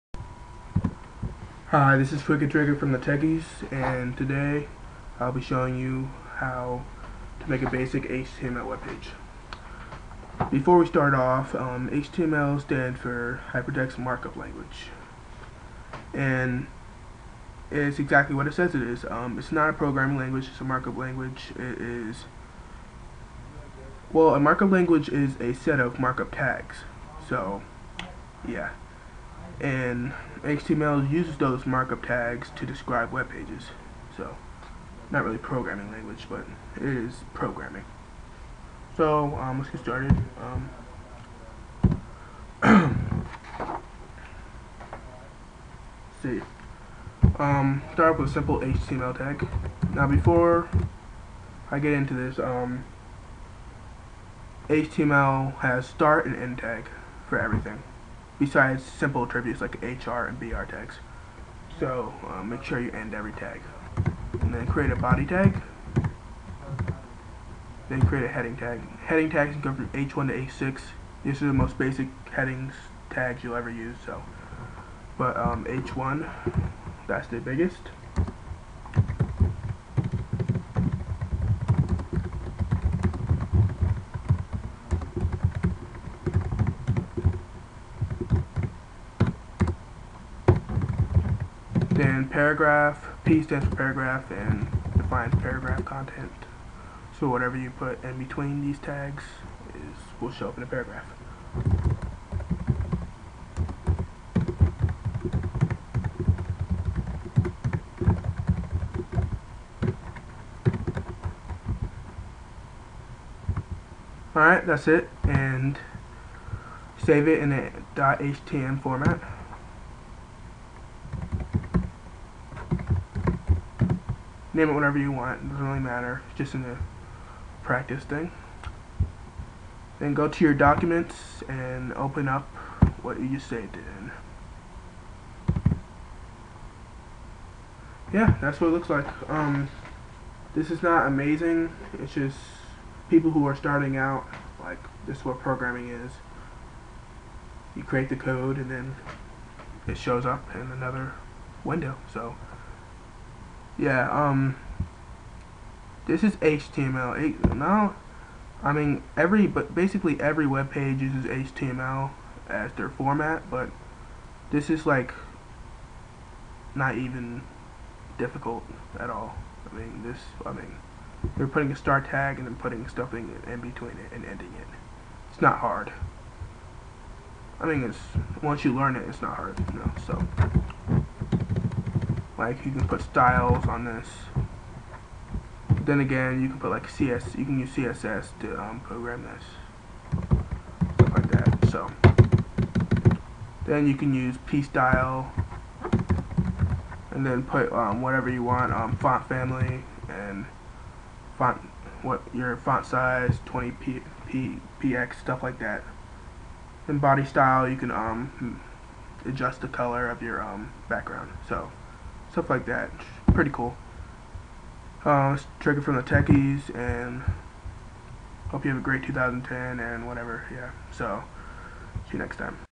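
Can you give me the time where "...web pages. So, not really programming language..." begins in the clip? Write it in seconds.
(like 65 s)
33 s.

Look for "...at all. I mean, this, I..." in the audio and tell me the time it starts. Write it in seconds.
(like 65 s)
168 s.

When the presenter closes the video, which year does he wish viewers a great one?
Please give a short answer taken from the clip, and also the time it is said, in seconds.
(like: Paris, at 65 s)
2010, at 219 s.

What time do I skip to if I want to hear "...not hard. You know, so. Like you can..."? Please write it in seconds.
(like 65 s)
179 s.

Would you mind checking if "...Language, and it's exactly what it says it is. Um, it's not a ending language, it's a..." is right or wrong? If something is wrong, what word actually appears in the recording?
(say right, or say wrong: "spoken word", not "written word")
wrong: "programming", not "ending".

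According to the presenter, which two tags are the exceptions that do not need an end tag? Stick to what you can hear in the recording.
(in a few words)
HR and BR.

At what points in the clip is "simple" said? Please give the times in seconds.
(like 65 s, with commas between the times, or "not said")
48 s, 58 s.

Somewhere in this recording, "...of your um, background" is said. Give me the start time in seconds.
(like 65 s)
210 s.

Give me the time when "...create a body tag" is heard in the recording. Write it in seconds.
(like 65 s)
64 s.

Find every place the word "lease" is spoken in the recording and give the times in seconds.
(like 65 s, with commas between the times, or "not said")
not said.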